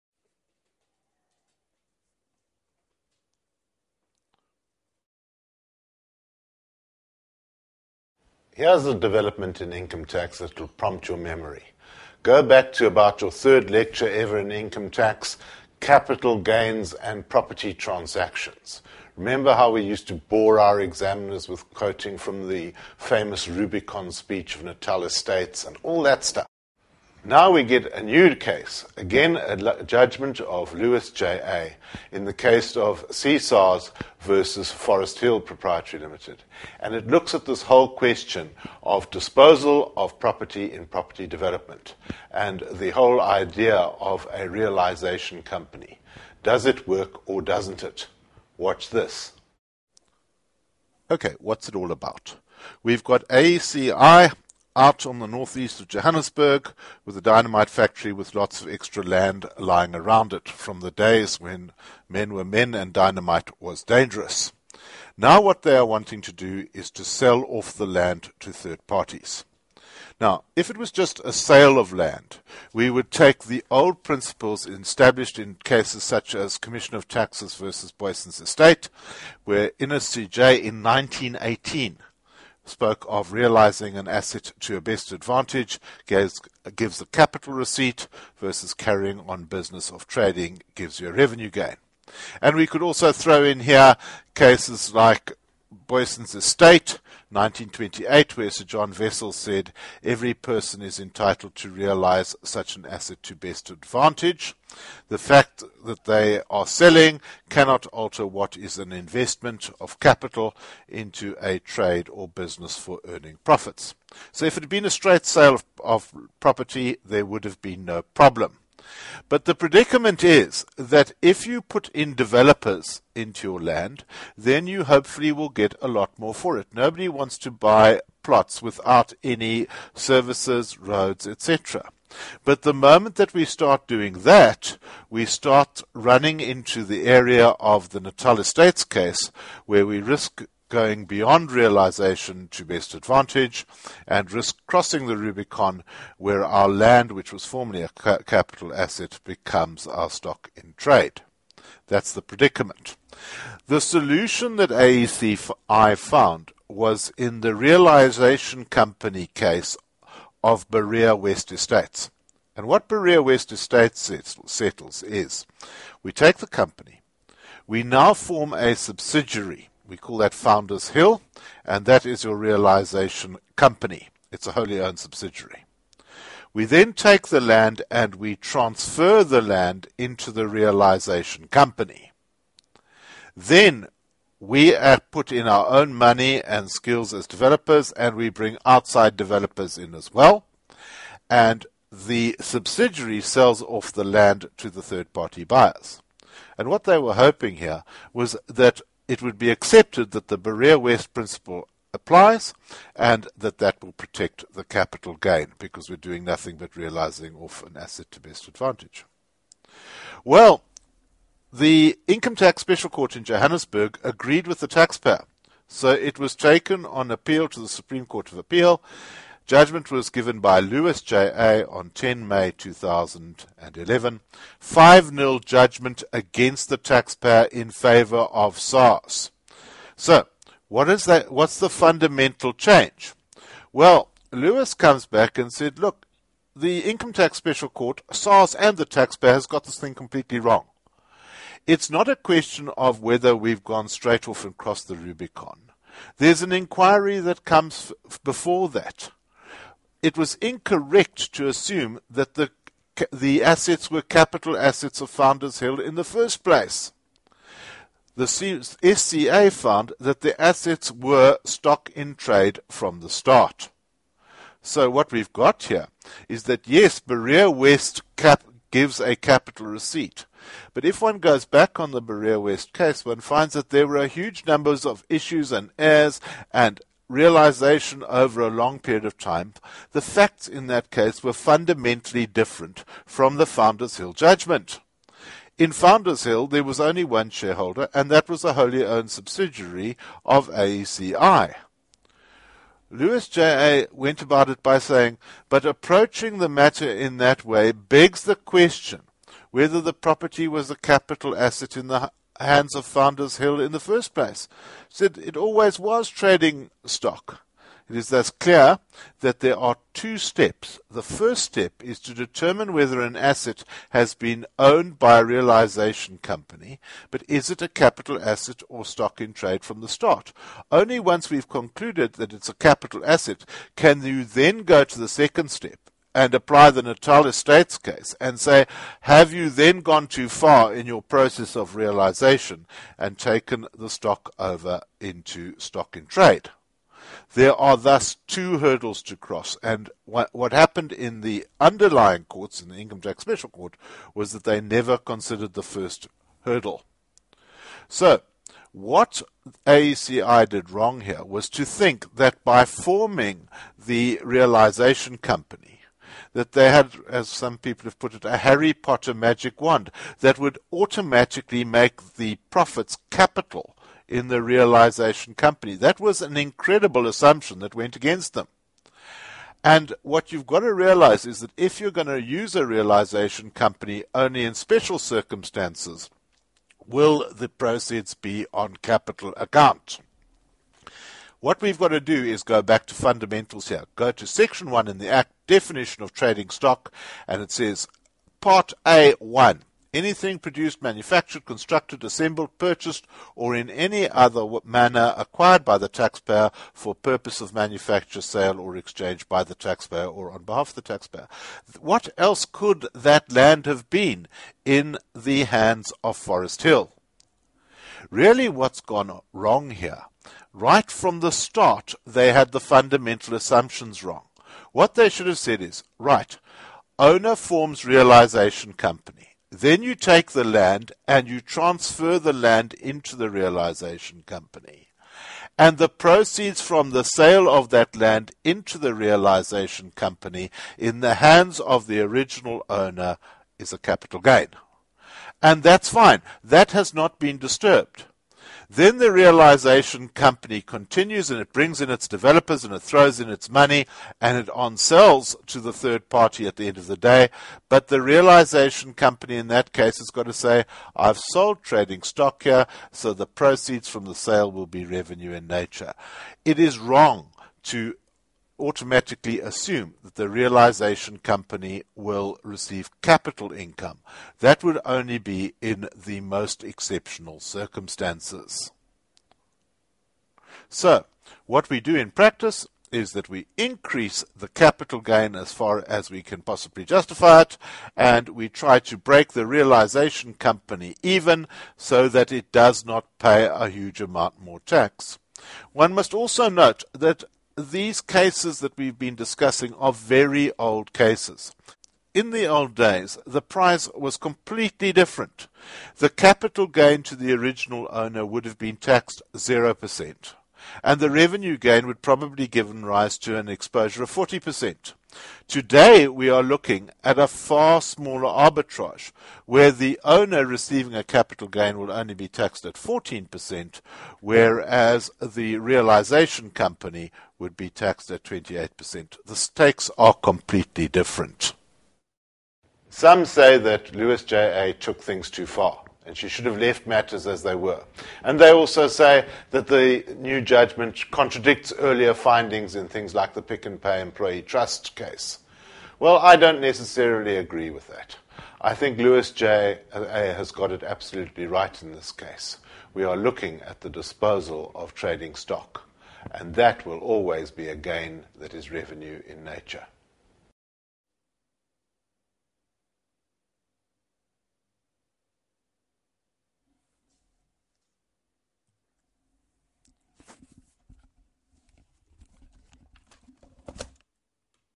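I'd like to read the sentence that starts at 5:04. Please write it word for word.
Said it always was trading stock.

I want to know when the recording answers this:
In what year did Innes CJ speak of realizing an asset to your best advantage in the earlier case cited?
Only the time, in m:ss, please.
1:20.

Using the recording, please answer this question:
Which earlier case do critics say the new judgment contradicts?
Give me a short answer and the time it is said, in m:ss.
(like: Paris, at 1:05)
Pick and Pay Employee Trust, at 8:53.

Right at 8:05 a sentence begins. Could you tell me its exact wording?
One must also note that these cases that we've been discussing are very old cases.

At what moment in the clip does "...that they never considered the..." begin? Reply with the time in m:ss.
5:44.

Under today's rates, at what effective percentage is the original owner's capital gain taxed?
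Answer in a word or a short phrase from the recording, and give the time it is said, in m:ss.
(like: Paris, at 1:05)
14%, at 8:32.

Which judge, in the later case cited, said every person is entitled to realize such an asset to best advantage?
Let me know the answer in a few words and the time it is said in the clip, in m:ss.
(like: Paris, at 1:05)
Sir John Wessels, at 1:38.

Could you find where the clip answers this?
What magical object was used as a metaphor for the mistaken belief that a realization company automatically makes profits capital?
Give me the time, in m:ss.
5:58.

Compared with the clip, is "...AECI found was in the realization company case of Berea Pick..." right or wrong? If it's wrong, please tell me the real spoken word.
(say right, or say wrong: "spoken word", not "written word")
wrong: "West", not "Pick".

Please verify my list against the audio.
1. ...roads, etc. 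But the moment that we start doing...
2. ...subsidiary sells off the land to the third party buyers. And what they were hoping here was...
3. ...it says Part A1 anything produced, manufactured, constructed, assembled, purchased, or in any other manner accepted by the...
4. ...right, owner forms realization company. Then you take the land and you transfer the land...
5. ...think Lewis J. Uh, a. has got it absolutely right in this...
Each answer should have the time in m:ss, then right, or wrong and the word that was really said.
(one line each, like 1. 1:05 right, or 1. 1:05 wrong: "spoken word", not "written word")
1. 2:10 right
2. 3:12 right
3. 6:27 wrong: "acquired", not "accepted"
4. 6:55 right
5. 8:58 right.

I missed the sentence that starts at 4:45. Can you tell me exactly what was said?
In Founders Hill, there was only one shareholder, and that was a wholly owned subsidiary of AECI.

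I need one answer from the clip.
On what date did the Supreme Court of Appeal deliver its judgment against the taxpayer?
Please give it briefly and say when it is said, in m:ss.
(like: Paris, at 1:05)
10 May 2011, at 3:41.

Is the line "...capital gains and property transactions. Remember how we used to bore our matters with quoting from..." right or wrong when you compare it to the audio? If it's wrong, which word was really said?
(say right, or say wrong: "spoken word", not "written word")
wrong: "examiners", not "matters".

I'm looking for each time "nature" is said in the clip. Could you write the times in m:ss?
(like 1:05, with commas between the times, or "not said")
7:35, 9:09.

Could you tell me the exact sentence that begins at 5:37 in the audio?
There are thus two hurdles to cross.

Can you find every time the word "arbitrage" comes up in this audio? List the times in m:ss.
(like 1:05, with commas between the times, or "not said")
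8:28.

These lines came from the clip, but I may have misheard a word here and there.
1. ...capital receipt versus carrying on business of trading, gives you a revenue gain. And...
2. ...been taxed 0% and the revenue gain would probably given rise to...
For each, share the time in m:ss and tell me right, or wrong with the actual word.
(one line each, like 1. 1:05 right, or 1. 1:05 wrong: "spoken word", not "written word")
1. 1:27 right
2. 8:18 right.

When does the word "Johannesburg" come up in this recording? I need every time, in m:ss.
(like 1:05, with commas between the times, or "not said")
0:55, 3:33.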